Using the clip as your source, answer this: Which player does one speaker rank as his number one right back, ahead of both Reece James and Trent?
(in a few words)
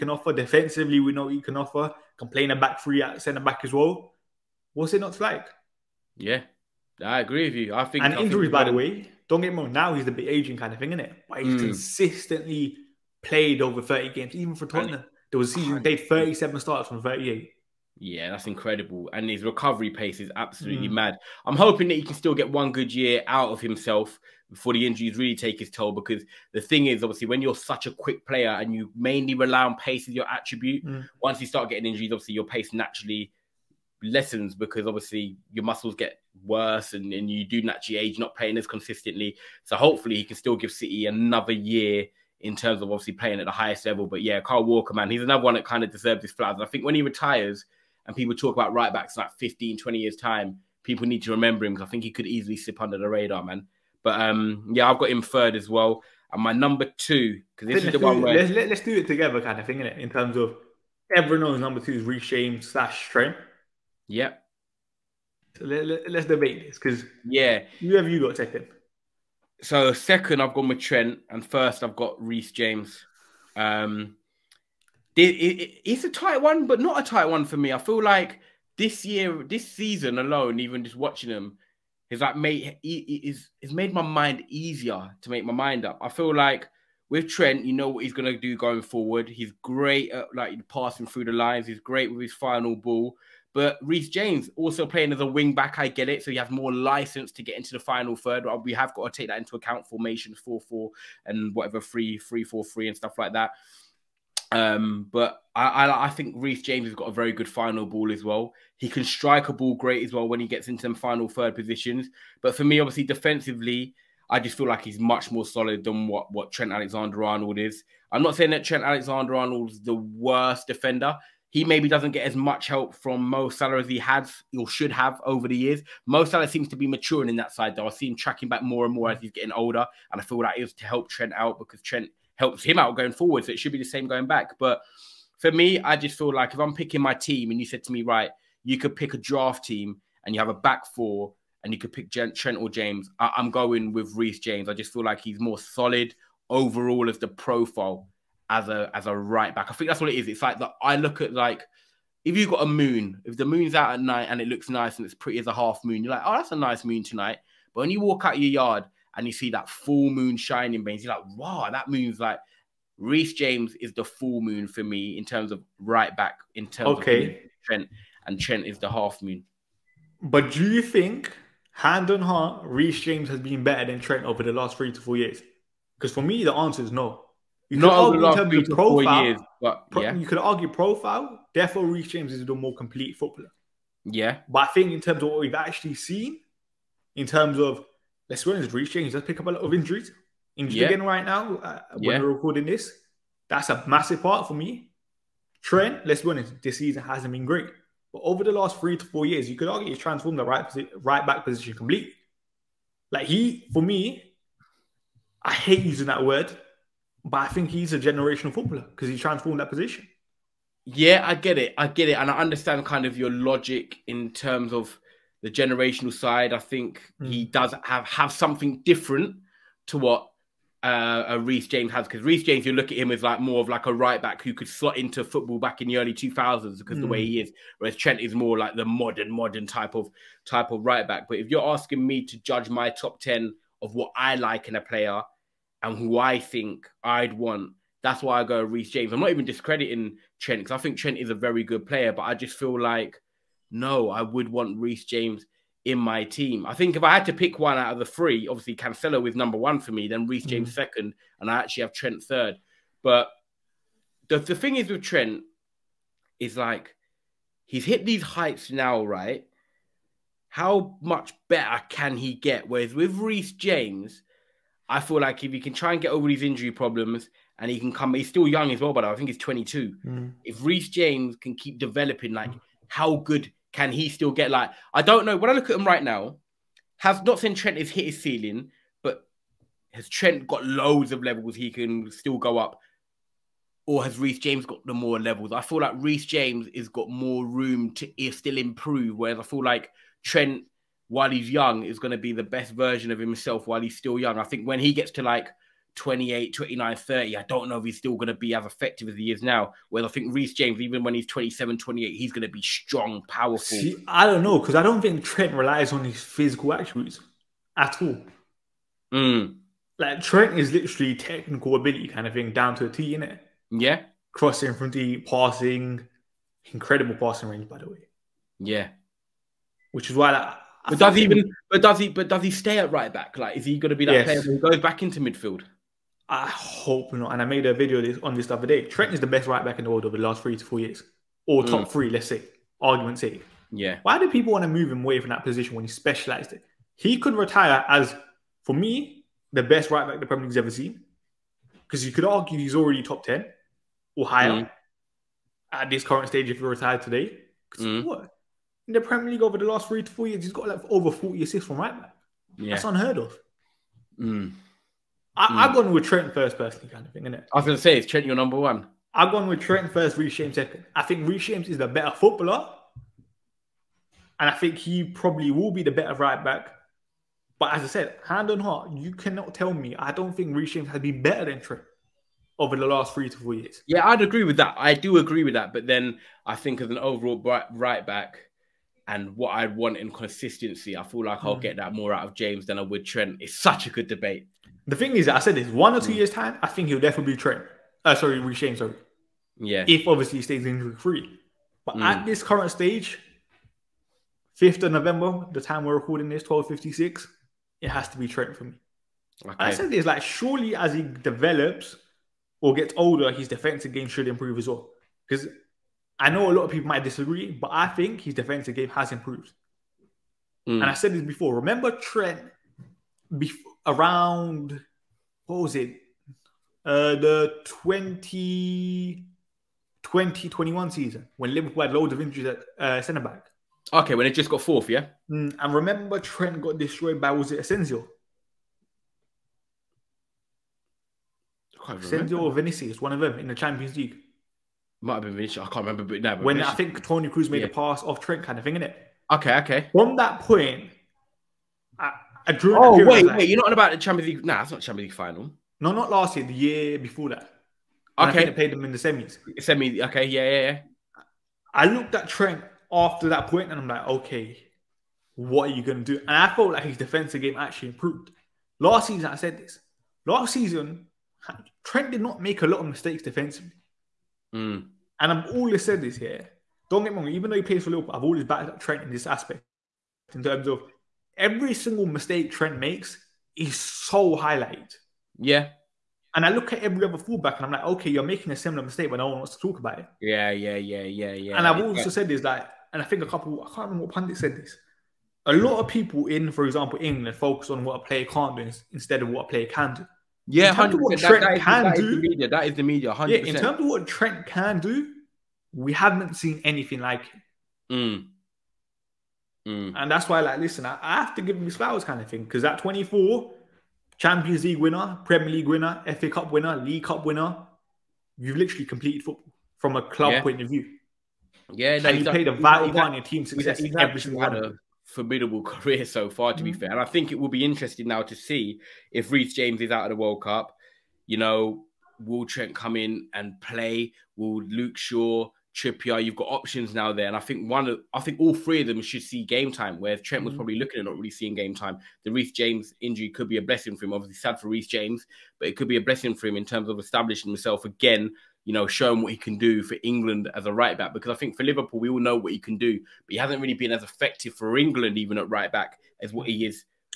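Cancelo.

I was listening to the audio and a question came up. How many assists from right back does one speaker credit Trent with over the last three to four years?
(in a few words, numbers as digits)
Over 40.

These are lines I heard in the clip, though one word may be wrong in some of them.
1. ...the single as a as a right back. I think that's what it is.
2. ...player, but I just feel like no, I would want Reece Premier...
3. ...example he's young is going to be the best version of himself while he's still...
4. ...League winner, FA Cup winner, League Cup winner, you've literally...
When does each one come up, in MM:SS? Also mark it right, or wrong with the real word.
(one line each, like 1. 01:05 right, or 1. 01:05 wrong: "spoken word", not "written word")
1. 02:27 wrong: "profile", not "single"
2. 04:01 wrong: "James", not "Premier"
3. 04:51 wrong: "while", not "example"
4. 08:25 right.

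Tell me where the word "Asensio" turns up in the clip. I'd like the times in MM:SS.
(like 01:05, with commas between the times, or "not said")
07:07, 07:11.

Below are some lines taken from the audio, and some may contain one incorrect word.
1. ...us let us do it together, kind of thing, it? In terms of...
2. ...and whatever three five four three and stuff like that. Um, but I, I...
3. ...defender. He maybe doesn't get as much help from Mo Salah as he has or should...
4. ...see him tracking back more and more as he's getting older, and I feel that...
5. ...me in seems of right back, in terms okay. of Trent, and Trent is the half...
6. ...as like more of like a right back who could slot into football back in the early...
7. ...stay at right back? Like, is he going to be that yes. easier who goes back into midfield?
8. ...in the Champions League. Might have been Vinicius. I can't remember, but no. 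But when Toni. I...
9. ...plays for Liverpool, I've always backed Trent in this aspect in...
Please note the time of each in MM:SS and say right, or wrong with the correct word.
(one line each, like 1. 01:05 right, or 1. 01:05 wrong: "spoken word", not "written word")
1. 00:58 right
2. 01:41 wrong: "three", not "five"
3. 02:00 right
4. 02:07 right
5. 02:44 wrong: "terms", not "seems"
6. 03:43 right
7. 05:22 wrong: "player", not "easier"
8. 07:13 wrong: "Vinicius", not "Toni"
9. 07:47 right.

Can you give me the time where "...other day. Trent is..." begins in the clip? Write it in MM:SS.
05:28.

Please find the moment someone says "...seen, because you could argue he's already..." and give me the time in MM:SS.
05:40.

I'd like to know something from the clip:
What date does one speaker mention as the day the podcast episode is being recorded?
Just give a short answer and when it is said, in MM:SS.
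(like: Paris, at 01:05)
5 November, at 06:34.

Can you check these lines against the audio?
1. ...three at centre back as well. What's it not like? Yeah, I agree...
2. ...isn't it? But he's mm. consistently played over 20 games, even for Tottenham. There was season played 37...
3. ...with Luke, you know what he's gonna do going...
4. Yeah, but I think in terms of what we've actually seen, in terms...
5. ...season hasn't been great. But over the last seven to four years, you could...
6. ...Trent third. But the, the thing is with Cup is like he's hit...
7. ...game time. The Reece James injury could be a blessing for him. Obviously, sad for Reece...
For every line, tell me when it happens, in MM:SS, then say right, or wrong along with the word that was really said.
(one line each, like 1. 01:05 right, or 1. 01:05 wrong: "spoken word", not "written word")
1. 00:02 right
2. 00:10 wrong: "30", not "20"
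3. 01:27 wrong: "Trent", not "Luke"
4. 03:04 right
5. 03:16 wrong: "three", not "seven"
6. 04:11 wrong: "Trent", not "Cup"
7. 08:51 right.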